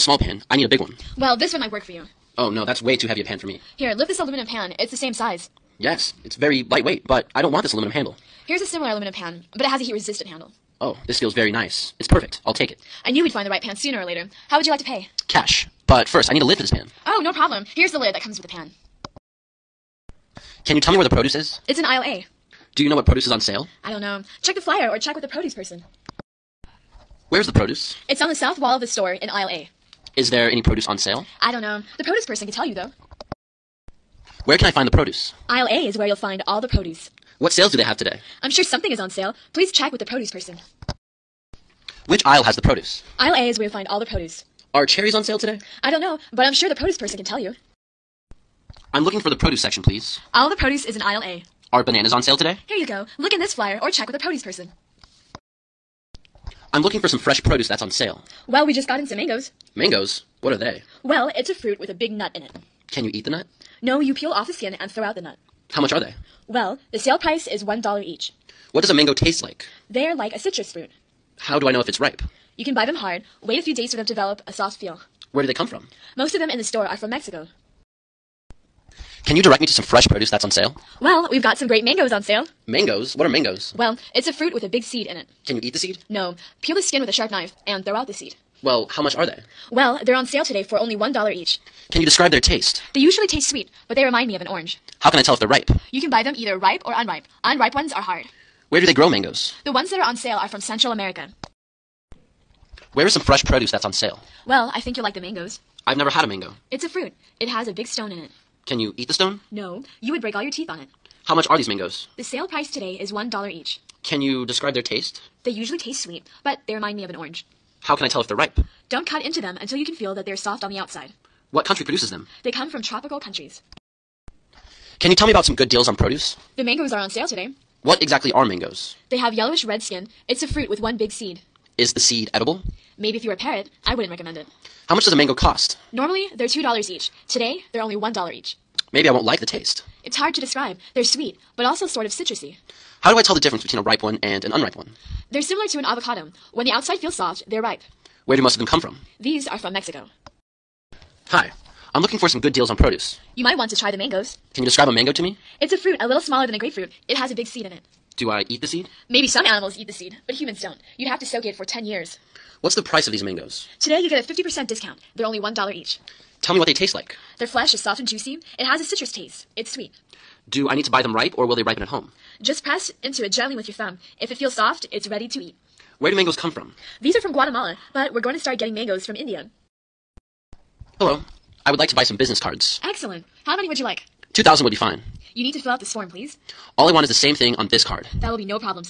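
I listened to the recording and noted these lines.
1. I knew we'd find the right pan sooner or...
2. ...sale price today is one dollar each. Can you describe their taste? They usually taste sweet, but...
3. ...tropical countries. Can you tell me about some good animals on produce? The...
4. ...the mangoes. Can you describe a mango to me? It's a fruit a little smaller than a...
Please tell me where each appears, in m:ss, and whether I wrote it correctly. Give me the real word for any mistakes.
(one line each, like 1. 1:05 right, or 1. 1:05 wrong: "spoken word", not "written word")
1. 0:13 right
2. 1:52 right
3. 2:02 wrong: "deals", not "animals"
4. 2:33 right.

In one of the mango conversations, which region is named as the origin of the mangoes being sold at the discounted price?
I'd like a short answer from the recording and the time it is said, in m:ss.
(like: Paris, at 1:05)
Central America, at 1:40.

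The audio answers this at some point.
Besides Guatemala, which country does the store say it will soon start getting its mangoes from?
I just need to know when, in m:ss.
2:59.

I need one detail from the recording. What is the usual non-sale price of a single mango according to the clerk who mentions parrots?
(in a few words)
$2.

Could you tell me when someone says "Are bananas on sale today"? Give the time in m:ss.
0:51.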